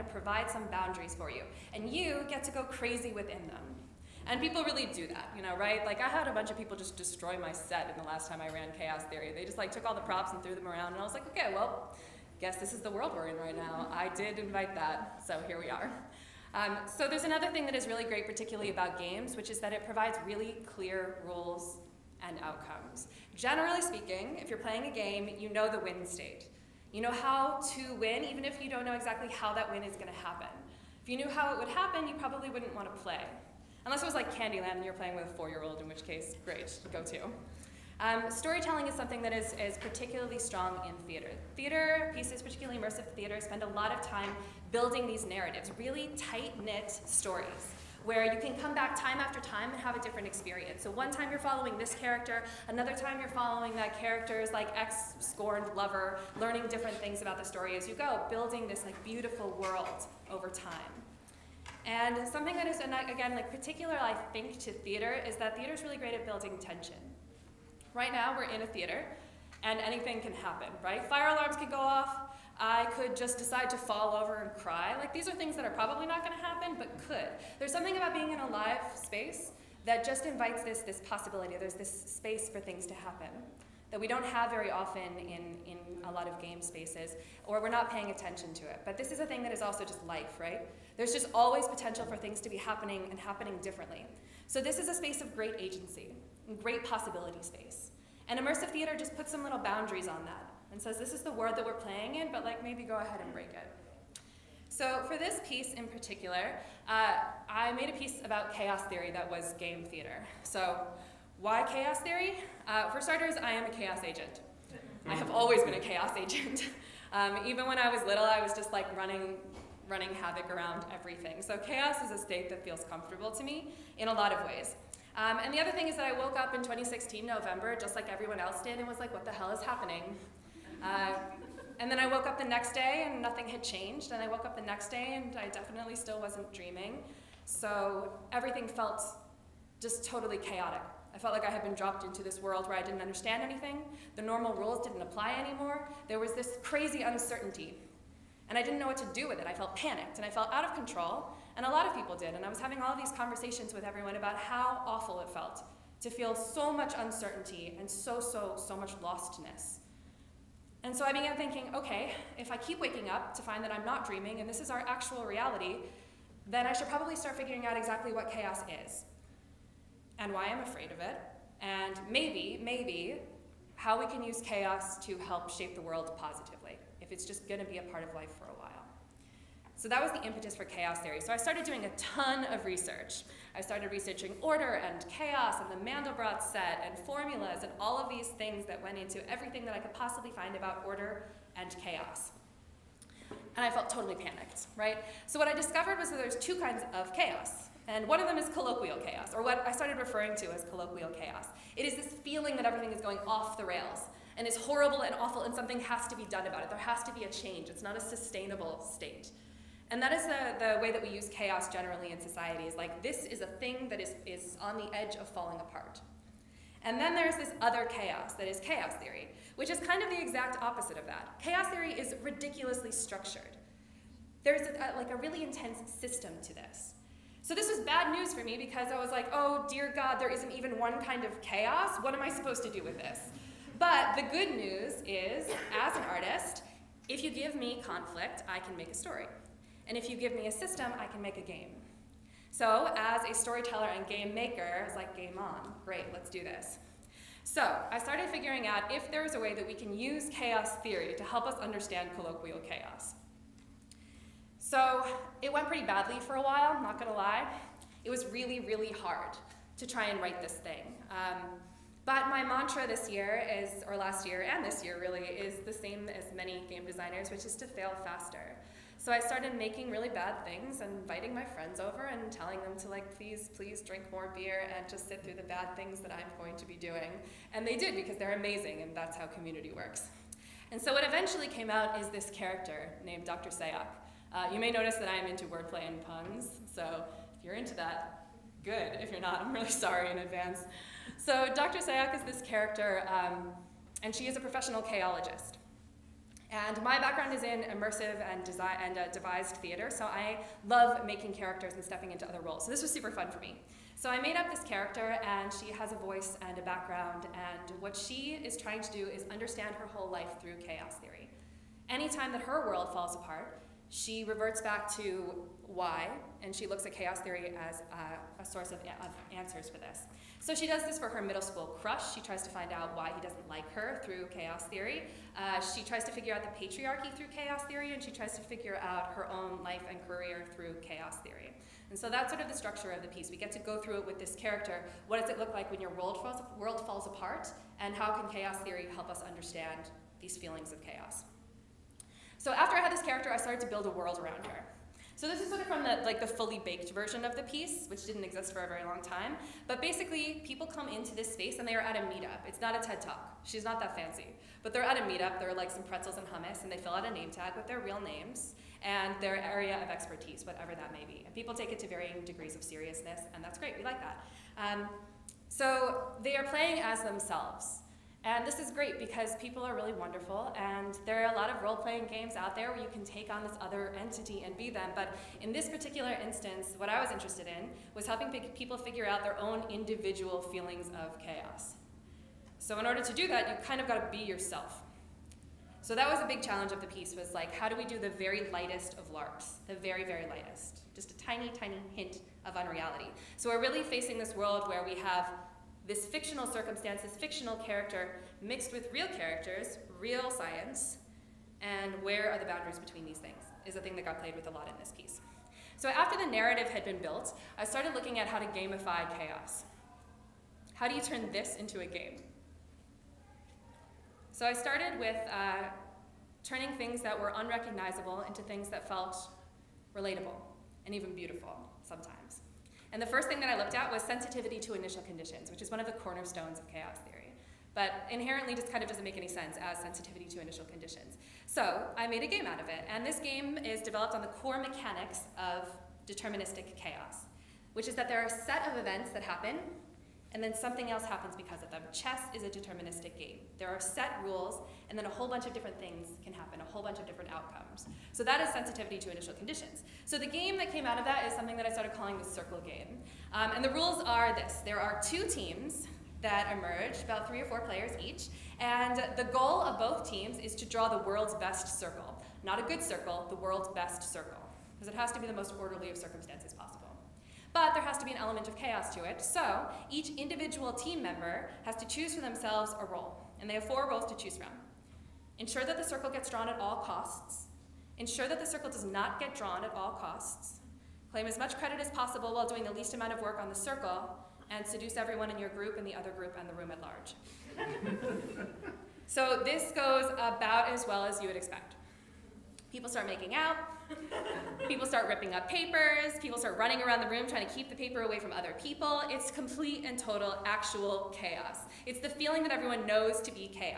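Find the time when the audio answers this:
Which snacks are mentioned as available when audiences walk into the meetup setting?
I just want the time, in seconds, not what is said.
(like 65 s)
355 s.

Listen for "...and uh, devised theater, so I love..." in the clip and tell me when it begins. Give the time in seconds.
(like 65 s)
298 s.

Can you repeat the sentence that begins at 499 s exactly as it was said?
It's complete and total actual chaos.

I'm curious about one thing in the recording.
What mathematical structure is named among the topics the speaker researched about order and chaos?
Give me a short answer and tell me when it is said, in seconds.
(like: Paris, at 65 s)
Mandelbrot set, at 185 s.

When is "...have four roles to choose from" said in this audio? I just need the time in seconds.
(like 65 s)
473 s.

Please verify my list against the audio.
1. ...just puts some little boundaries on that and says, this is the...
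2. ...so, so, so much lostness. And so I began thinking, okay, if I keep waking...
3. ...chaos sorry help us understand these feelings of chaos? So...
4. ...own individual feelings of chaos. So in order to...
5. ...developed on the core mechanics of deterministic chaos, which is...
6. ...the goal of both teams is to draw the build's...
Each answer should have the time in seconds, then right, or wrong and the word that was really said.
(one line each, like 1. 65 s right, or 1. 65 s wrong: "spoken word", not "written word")
1. 98 s right
2. 157 s right
3. 338 s wrong: "theory", not "sorry"
4. 379 s right
5. 433 s right
6. 459 s wrong: "world", not "build".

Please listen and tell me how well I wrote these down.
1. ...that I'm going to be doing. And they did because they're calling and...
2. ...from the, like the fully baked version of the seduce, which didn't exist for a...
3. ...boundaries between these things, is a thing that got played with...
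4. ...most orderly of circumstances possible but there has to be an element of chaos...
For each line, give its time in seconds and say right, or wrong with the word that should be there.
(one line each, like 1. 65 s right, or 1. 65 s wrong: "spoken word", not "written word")
1. 275 s wrong: "amazing", not "calling"
2. 345 s wrong: "piece", not "seduce"
3. 402 s right
4. 465 s right.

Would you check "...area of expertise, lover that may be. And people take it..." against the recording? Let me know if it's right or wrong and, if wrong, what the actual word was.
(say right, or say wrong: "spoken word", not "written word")
wrong: "whatever", not "lover".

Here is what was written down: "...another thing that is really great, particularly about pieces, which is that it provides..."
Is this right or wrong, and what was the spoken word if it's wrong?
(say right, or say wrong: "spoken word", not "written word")
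wrong: "games", not "pieces".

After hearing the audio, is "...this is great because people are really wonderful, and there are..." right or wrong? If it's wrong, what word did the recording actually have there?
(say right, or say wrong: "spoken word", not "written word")
right.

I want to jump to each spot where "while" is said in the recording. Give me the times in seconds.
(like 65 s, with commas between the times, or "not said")
178 s, 256 s, 482 s.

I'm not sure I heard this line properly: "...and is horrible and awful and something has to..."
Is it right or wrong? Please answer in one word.
right.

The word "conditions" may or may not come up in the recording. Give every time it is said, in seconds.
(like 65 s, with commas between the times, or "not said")
425 s, 430 s, 449 s.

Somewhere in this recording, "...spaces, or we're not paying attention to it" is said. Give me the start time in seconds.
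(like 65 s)
86 s.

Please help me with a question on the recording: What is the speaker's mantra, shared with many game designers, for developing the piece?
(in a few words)
fail faster.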